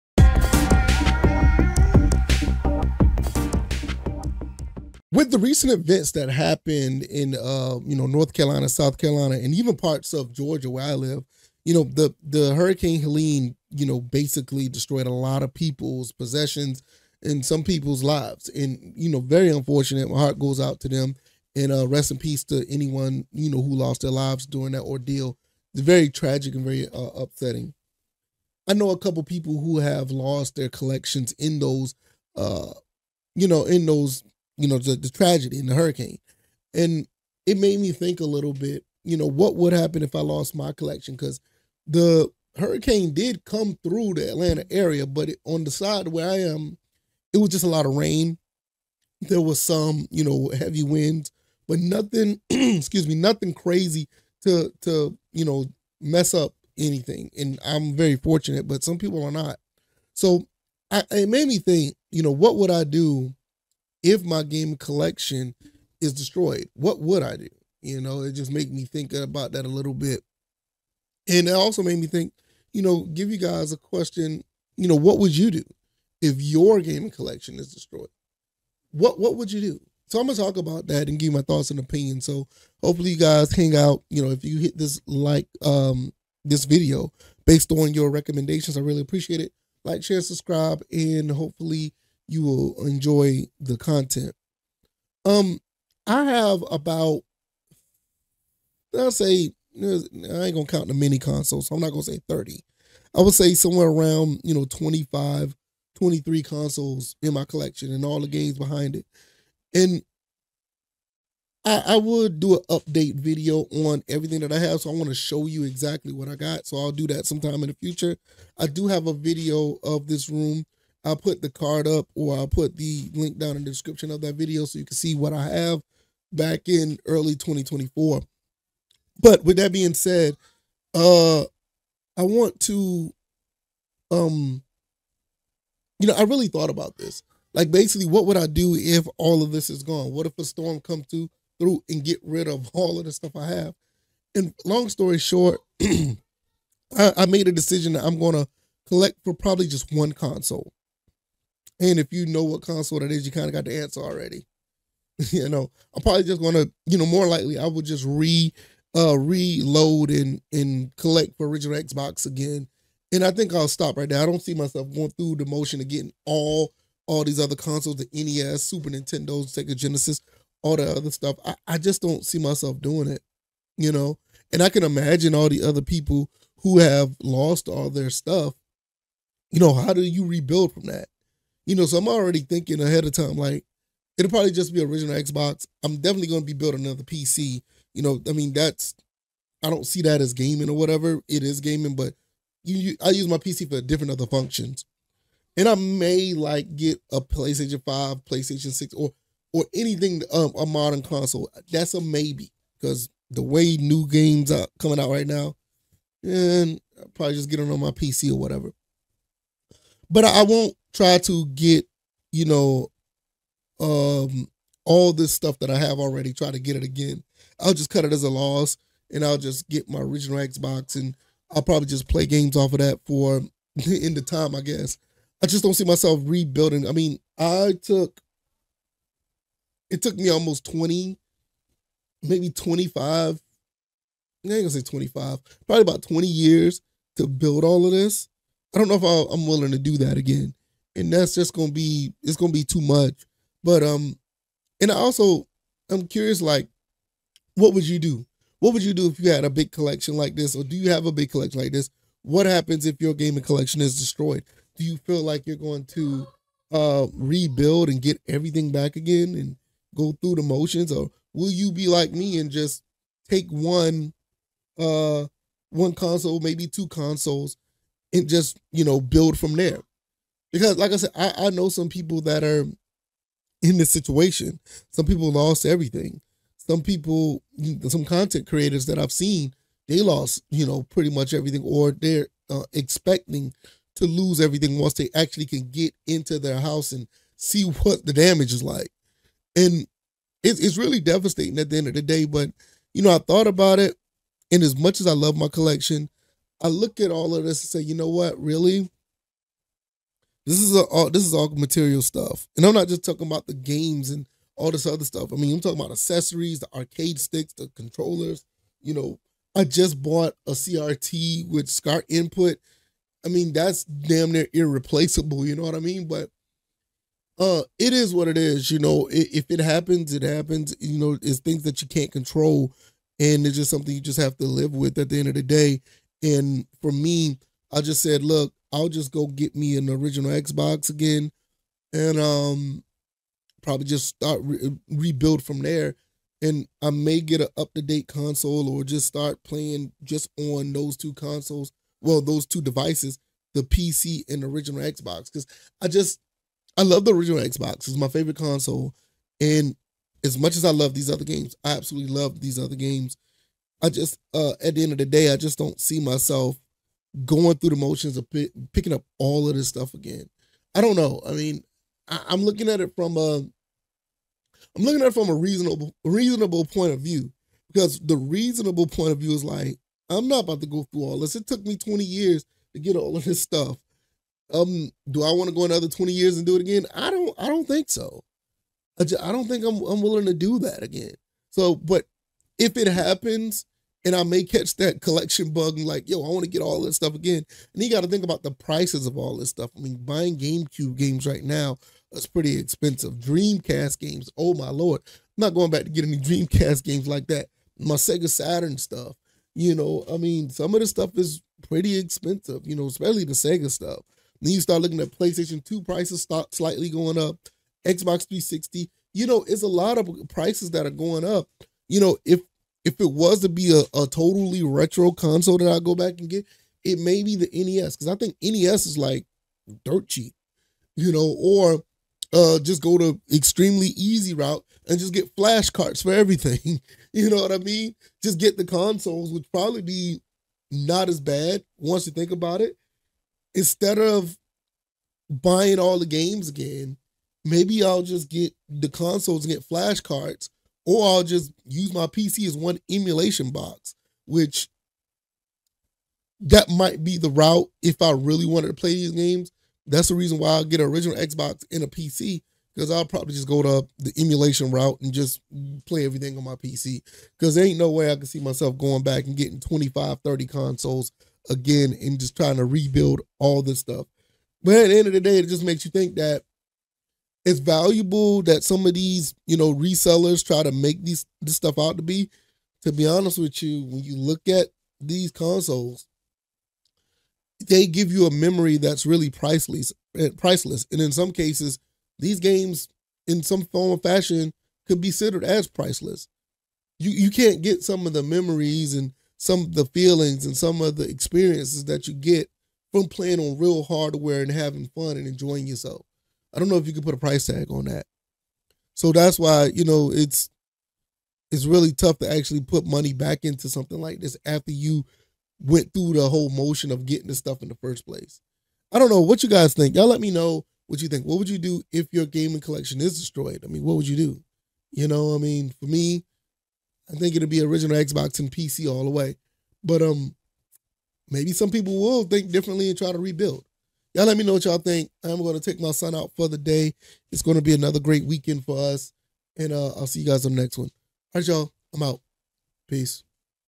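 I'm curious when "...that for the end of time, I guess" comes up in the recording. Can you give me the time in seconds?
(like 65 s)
222 s.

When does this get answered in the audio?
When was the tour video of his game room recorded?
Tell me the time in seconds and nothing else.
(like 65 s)
127 s.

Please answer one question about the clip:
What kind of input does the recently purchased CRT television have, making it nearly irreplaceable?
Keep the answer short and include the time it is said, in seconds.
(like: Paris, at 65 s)
SCART, at 311 s.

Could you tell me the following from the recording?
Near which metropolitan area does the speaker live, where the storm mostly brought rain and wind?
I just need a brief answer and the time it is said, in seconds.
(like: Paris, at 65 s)
Atlanta, at 44 s.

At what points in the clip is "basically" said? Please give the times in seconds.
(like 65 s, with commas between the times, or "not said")
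13 s, 137 s.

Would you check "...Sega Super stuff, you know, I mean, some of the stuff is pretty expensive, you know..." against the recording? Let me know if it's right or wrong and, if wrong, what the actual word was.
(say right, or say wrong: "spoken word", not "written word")
wrong: "Saturn", not "Super".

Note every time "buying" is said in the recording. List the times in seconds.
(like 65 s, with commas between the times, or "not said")
389 s, 435 s.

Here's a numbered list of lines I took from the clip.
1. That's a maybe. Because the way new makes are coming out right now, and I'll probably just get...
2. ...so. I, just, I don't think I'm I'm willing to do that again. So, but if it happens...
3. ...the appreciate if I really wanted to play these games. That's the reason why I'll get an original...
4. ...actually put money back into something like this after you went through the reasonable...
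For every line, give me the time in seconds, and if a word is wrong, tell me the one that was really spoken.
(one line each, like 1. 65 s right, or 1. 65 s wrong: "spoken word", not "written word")
1. 201 s wrong: "games", not "makes"
2. 377 s right
3. 447 s wrong: "route", not "appreciate"
4. 502 s wrong: "whole", not "reasonable".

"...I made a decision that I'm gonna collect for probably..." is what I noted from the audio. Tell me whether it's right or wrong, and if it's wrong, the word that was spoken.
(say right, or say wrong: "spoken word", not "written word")
right.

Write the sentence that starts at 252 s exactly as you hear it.
What happens if your gaming collection is destroyed?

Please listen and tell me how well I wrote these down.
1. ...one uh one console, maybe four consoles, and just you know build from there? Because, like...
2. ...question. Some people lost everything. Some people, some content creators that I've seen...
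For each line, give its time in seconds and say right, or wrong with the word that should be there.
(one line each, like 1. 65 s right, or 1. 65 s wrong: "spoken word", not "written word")
1. 263 s wrong: "two", not "four"
2. 273 s wrong: "situation", not "question".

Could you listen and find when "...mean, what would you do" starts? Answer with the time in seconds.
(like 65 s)
513 s.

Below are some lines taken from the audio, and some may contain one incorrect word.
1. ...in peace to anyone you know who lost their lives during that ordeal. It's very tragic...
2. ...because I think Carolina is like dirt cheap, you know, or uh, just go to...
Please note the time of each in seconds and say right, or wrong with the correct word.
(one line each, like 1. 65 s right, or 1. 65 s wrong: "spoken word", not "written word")
1. 22 s right
2. 417 s wrong: "NES", not "Carolina".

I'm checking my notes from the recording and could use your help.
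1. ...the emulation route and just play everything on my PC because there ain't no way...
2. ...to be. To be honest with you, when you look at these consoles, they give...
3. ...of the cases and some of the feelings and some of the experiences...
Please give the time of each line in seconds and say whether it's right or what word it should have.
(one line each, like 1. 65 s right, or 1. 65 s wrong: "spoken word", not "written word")
1. 453 s right
2. 471 s right
3. 488 s wrong: "memories", not "cases".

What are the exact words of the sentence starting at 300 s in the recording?
This is a, all this is all material stuff, and I'm not just talking about the games and all this other stuff.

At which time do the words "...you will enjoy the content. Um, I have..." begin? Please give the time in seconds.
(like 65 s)
92 s.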